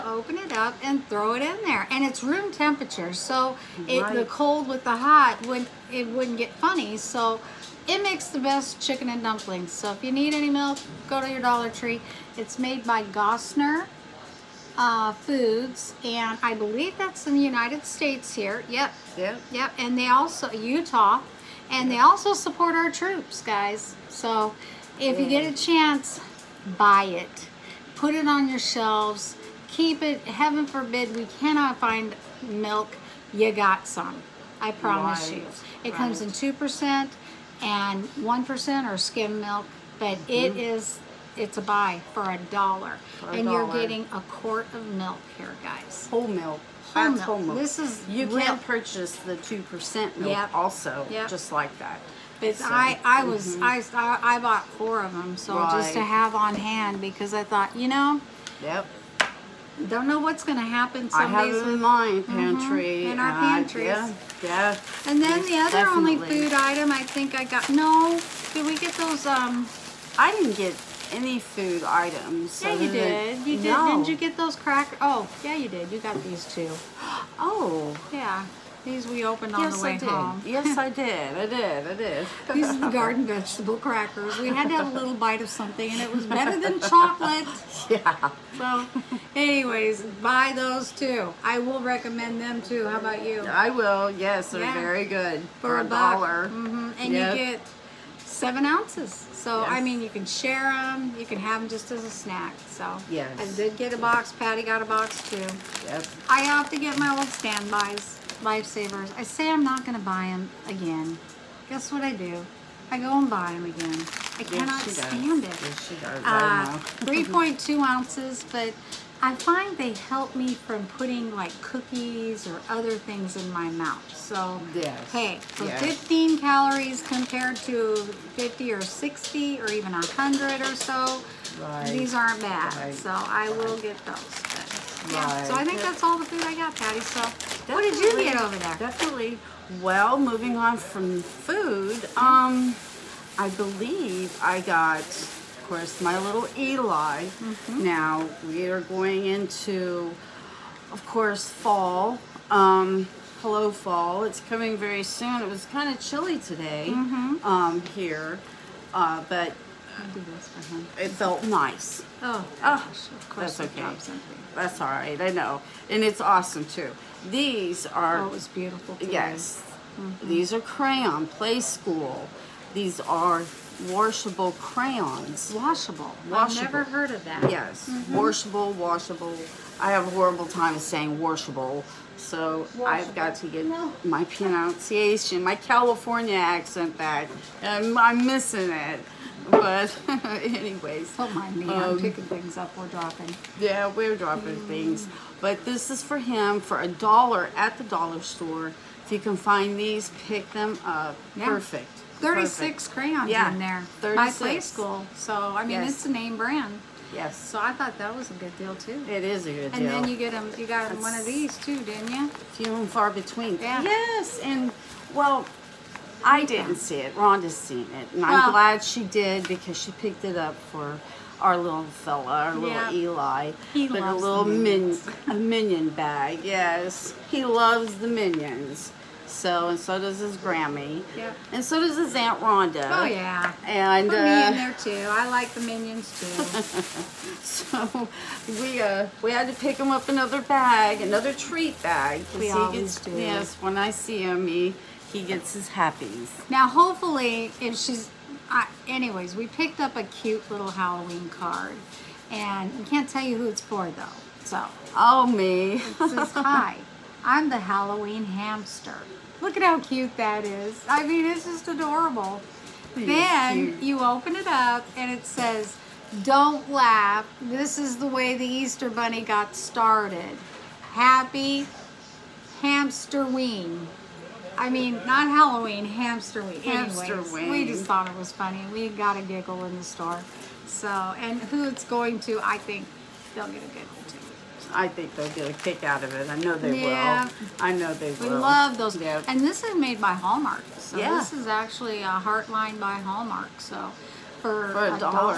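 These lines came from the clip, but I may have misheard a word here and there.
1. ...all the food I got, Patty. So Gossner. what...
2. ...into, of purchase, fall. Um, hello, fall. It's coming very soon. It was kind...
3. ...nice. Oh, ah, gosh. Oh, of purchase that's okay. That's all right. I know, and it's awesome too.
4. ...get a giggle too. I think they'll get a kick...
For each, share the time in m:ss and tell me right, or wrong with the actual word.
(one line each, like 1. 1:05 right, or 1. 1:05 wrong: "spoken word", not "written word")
1. 2:16 wrong: "Definitely", not "Gossner"
2. 2:29 wrong: "course", not "purchase"
3. 2:41 wrong: "course", not "purchase"
4. 4:43 right.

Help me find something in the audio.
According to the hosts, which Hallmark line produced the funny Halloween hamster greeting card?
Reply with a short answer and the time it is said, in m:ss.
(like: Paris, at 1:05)
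Heartline, at 4:52.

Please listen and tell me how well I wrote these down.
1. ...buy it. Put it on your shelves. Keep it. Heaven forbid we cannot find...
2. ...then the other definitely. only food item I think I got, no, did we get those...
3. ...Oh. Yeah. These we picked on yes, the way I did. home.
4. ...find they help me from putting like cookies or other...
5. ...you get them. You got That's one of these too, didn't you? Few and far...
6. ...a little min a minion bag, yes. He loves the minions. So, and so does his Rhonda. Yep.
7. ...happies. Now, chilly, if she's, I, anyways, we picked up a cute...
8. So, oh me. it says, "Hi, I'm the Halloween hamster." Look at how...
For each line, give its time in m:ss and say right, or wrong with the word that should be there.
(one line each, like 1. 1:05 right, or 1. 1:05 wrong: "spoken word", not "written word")
1. 0:26 right
2. 1:05 right
3. 1:17 wrong: "opened", not "picked"
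4. 1:59 right
5. 3:30 right
6. 3:44 wrong: "Grammy", not "Rhonda"
7. 4:05 wrong: "hopefully", not "chilly"
8. 4:14 right.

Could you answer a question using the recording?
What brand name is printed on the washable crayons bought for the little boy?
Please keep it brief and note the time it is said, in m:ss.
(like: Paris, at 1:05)
Playskool, at 2:51.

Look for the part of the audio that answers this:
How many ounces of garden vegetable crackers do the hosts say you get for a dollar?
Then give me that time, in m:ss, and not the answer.
1:38.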